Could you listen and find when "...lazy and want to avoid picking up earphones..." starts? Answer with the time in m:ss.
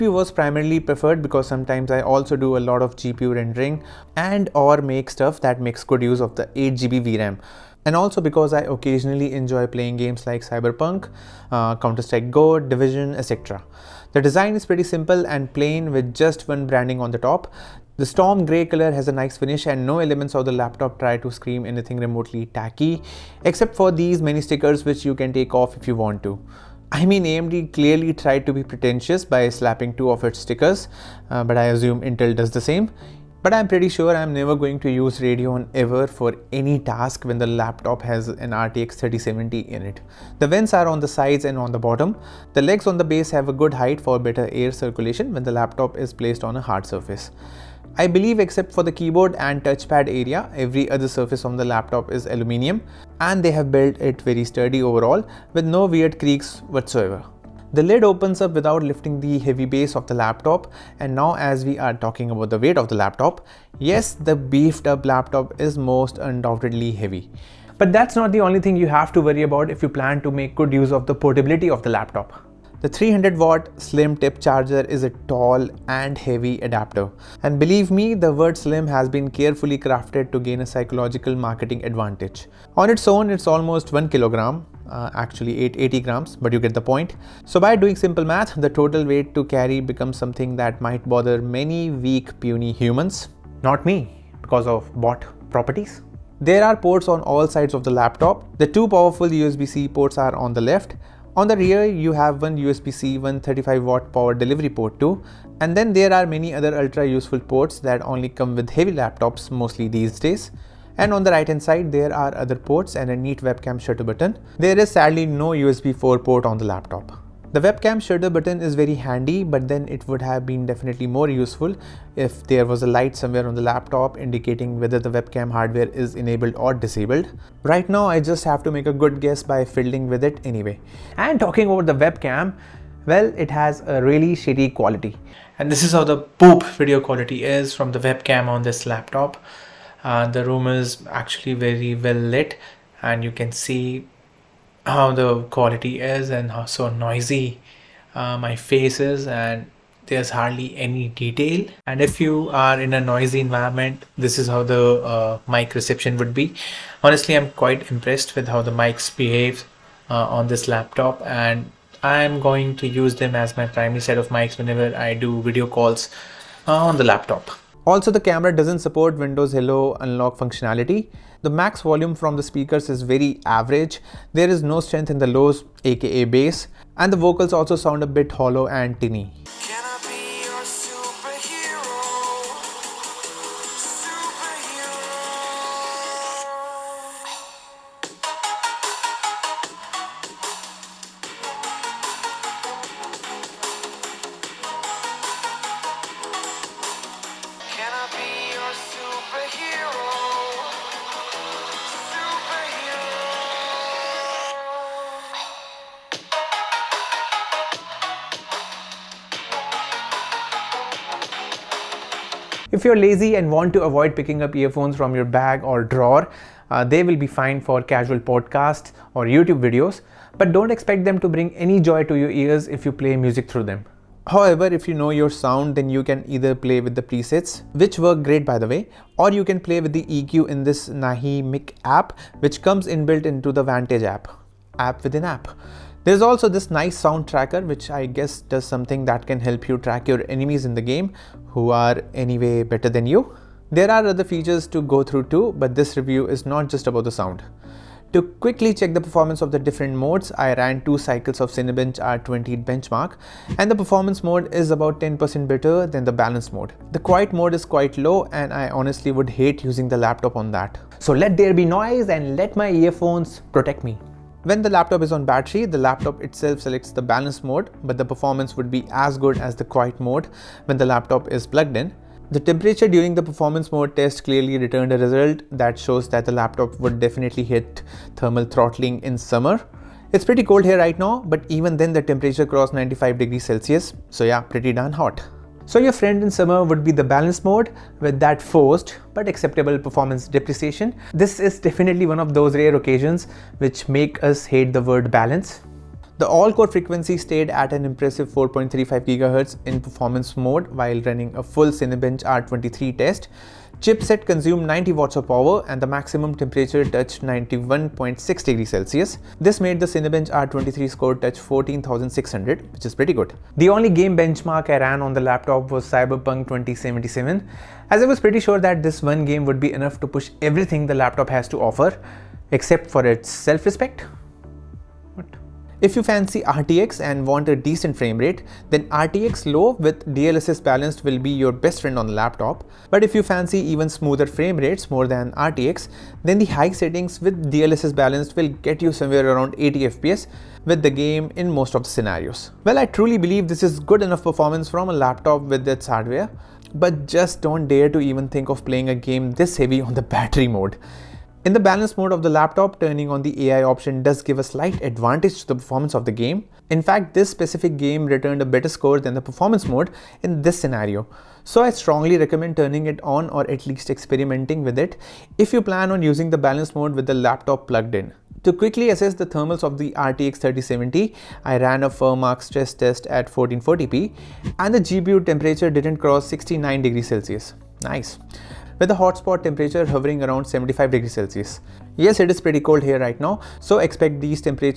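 3:32.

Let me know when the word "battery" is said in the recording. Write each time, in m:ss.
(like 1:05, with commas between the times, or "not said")
4:25, 5:50.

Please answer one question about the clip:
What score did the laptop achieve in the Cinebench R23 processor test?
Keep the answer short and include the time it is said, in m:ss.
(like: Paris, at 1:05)
14,600, at 5:11.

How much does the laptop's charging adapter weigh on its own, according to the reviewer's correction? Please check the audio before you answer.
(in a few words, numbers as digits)
880 grams.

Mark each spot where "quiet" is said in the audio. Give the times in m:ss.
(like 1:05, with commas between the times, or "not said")
4:17, 4:29.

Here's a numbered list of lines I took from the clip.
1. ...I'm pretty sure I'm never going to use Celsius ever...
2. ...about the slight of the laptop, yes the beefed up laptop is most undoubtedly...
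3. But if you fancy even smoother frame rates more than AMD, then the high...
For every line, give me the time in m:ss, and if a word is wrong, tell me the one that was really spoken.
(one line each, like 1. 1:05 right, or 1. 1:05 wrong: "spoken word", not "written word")
1. 0:33 wrong: "Radeon", not "Celsius"
2. 1:02 wrong: "weight", not "slight"
3. 5:32 wrong: "RTX", not "AMD".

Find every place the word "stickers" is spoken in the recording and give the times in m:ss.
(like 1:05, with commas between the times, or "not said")
0:24, 0:30.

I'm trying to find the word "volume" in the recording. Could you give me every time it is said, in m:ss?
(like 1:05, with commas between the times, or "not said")
2:51.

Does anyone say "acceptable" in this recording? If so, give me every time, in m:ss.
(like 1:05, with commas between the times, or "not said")
4:49.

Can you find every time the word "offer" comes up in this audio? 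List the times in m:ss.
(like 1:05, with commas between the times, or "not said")
5:21.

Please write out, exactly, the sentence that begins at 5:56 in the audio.
In fact, this specific game returned a better score than the performance mode in this scenario.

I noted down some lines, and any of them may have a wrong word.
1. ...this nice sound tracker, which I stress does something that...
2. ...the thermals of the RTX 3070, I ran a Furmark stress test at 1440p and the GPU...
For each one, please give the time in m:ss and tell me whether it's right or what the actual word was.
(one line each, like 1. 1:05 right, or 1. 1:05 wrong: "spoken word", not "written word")
1. 3:56 wrong: "guess", not "stress"
2. 6:09 right.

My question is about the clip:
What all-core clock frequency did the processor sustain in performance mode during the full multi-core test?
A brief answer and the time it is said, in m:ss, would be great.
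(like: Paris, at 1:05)
4.35 GHz, at 4:58.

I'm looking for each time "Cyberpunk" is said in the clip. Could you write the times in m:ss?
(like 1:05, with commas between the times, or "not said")
0:10, 5:15.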